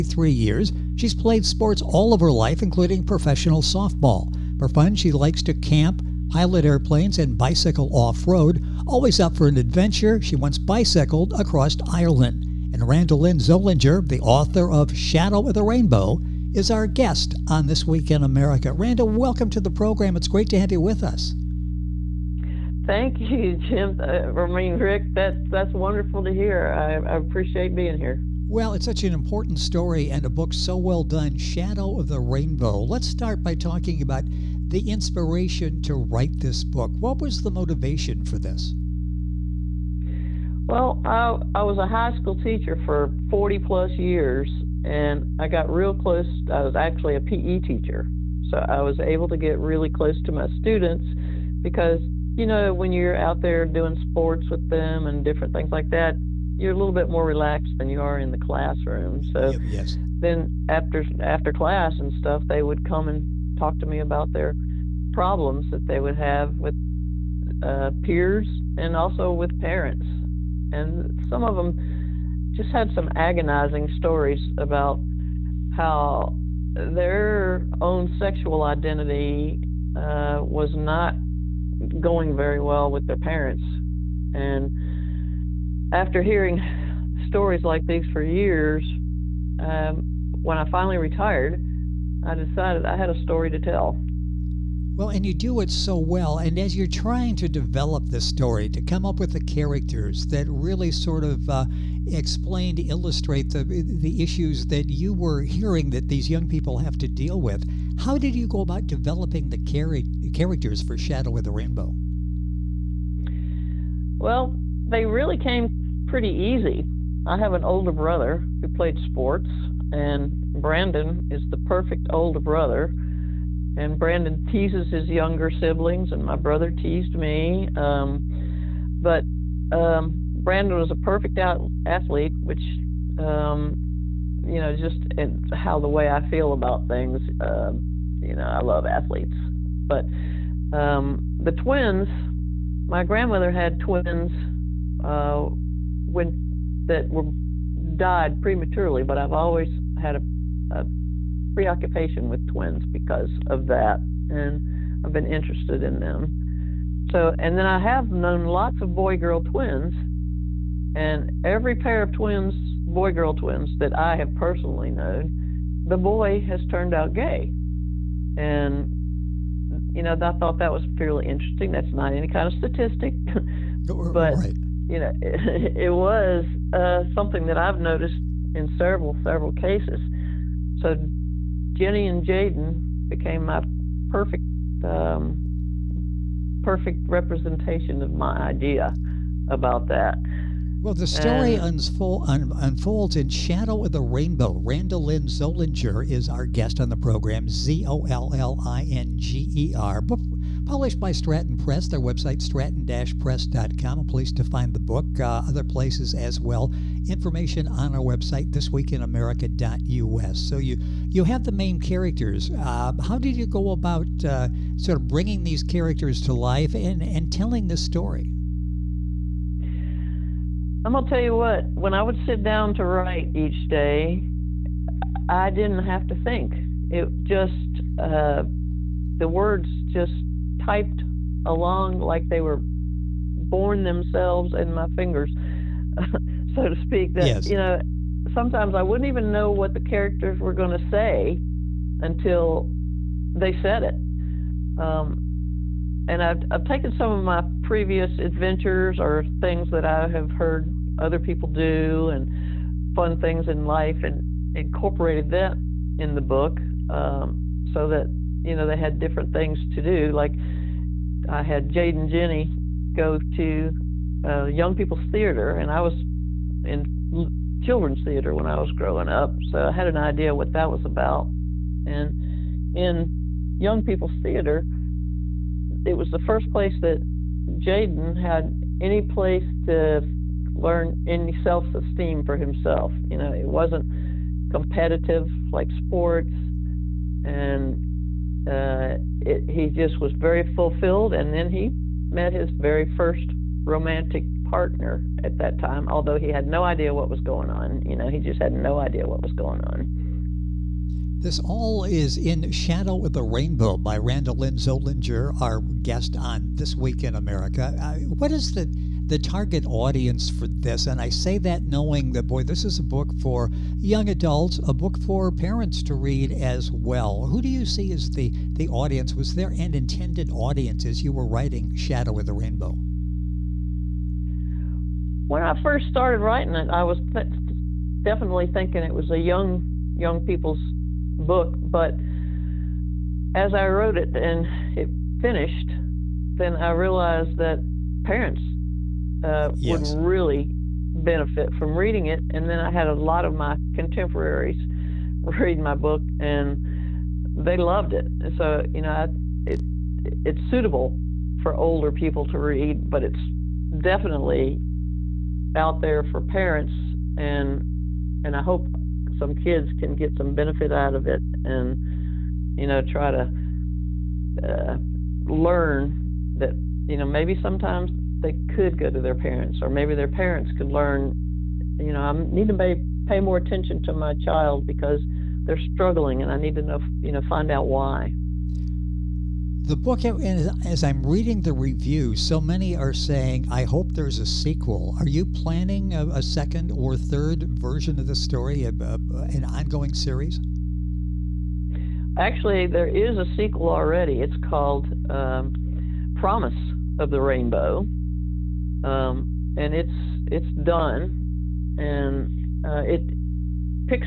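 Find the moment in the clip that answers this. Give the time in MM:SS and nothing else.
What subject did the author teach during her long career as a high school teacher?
00:47.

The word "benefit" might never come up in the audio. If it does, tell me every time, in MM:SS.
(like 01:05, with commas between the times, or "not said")
05:40, 06:00.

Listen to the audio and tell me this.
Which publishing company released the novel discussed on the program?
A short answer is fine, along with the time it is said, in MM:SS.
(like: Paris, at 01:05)
Stratton Press, at 03:21.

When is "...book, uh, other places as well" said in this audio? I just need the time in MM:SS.
03:24.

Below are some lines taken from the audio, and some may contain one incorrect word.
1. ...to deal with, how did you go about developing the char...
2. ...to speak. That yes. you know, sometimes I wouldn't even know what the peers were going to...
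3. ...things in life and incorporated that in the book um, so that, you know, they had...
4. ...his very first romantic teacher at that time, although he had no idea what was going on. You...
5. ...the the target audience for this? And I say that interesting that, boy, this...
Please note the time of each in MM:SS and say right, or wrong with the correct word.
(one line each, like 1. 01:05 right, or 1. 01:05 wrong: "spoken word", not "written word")
1. 01:46 right
2. 03:56 wrong: "characters", not "peers"
3. 04:13 right
4. 04:52 wrong: "partner", not "teacher"
5. 05:08 wrong: "knowing", not "interesting".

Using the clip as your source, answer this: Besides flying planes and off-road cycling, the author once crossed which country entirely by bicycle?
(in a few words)
Ireland.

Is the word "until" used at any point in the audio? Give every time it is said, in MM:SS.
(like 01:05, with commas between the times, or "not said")
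04:01.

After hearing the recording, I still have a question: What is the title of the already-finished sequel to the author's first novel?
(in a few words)
Promise of the Rainbow.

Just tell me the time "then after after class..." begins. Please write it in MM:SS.
01:00.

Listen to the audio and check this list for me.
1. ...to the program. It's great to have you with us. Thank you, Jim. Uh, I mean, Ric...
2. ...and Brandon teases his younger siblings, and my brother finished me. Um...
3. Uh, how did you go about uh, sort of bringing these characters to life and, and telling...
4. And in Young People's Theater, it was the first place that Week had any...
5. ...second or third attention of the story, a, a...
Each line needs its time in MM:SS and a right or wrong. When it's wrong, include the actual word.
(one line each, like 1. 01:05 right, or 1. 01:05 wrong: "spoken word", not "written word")
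1. 00:19 right
2. 02:03 wrong: "teased", not "finished"
3. 03:32 right
4. 04:31 wrong: "Jaden", not "Week"
5. 06:26 wrong: "version", not "attention".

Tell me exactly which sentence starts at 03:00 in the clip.
So, Jenny and Jaden became my perfect um, perfect representation of my idea about that.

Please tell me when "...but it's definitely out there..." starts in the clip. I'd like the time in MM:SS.
05:52.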